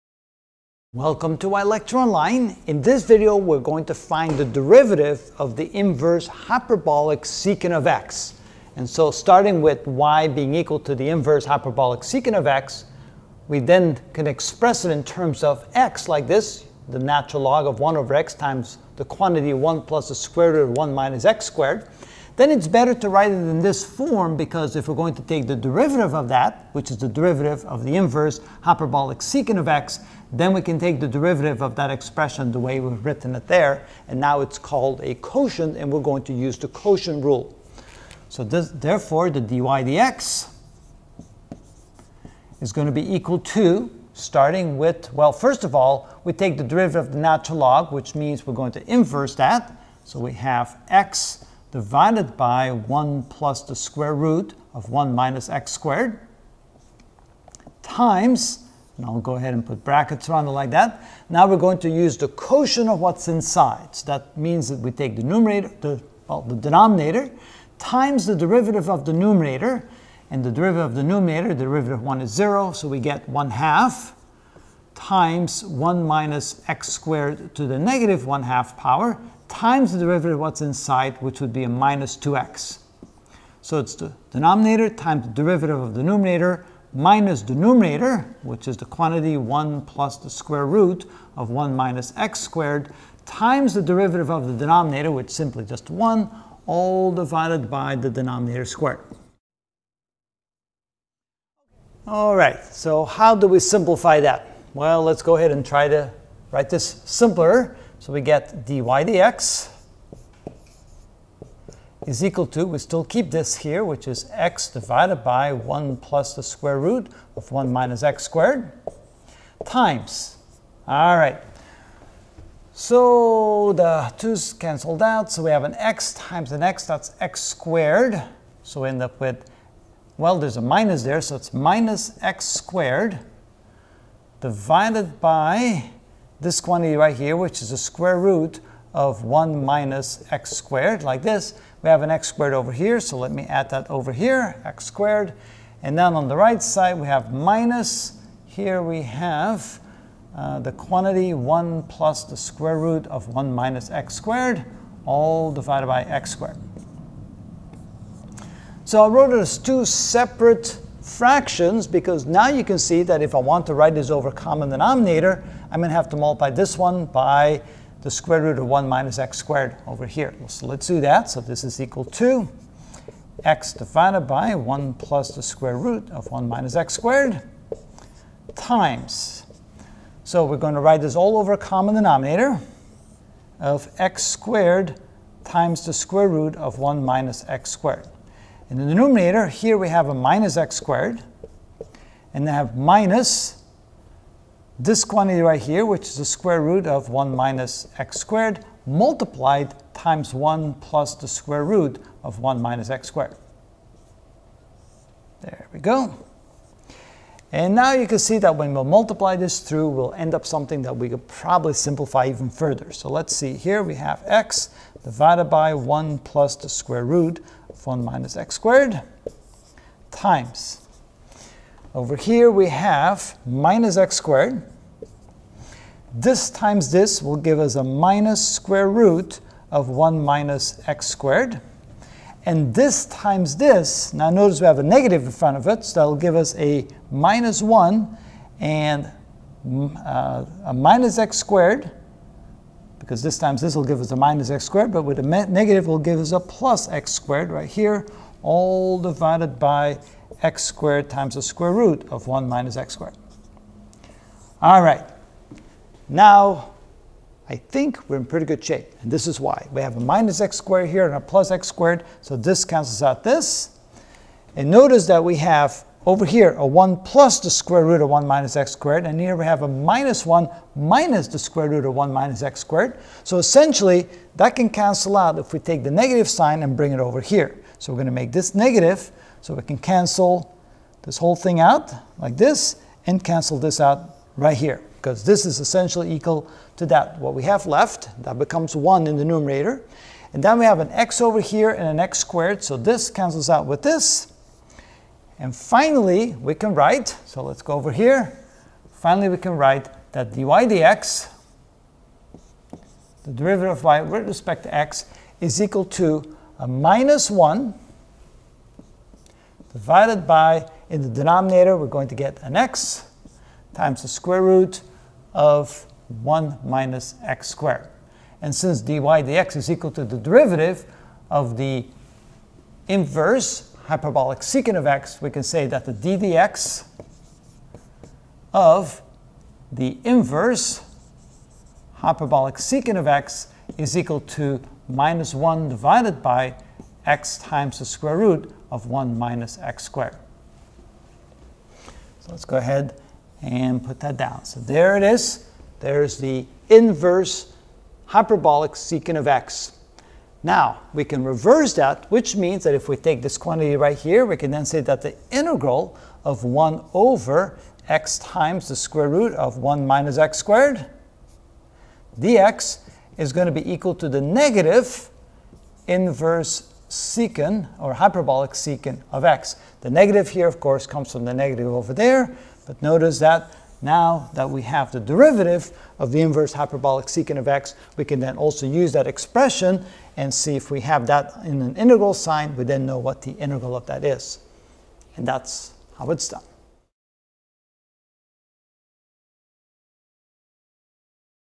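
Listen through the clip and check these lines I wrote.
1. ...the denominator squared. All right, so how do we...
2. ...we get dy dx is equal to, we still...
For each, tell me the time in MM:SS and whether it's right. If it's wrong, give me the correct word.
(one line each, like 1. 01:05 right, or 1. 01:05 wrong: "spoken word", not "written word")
1. 01:37 right
2. 01:48 right.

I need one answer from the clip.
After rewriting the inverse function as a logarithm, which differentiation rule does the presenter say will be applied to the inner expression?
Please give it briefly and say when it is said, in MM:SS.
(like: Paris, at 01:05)
quotient rule, at 00:36.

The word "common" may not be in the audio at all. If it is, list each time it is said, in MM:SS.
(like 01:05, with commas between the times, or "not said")
02:44, 03:01.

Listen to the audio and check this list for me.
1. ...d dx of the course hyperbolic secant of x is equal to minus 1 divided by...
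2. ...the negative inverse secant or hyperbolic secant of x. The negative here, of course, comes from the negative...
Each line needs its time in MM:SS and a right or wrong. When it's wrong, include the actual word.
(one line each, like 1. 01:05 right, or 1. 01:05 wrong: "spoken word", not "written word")
1. 05:25 wrong: "inverse", not "course"
2. 06:04 right.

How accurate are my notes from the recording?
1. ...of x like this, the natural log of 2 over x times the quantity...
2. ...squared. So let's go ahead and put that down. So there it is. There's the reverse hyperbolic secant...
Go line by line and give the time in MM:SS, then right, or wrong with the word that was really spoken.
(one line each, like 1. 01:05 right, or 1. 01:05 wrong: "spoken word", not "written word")
1. 00:15 wrong: "1", not "2"
2. 05:39 wrong: "inverse", not "reverse".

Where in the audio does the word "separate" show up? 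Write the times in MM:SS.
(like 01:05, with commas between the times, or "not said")
02:39.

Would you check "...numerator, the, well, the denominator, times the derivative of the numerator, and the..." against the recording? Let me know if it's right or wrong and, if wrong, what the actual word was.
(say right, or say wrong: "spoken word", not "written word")
right.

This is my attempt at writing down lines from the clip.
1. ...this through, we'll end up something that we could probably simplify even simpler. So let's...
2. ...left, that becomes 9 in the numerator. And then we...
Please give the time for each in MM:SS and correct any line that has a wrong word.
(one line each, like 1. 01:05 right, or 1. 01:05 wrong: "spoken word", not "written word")
1. 03:29 wrong: "further", not "simpler"
2. 04:47 wrong: "1", not "9".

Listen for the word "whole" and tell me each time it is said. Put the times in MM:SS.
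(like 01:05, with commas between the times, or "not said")
04:41.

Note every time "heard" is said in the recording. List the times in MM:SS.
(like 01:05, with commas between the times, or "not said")
not said.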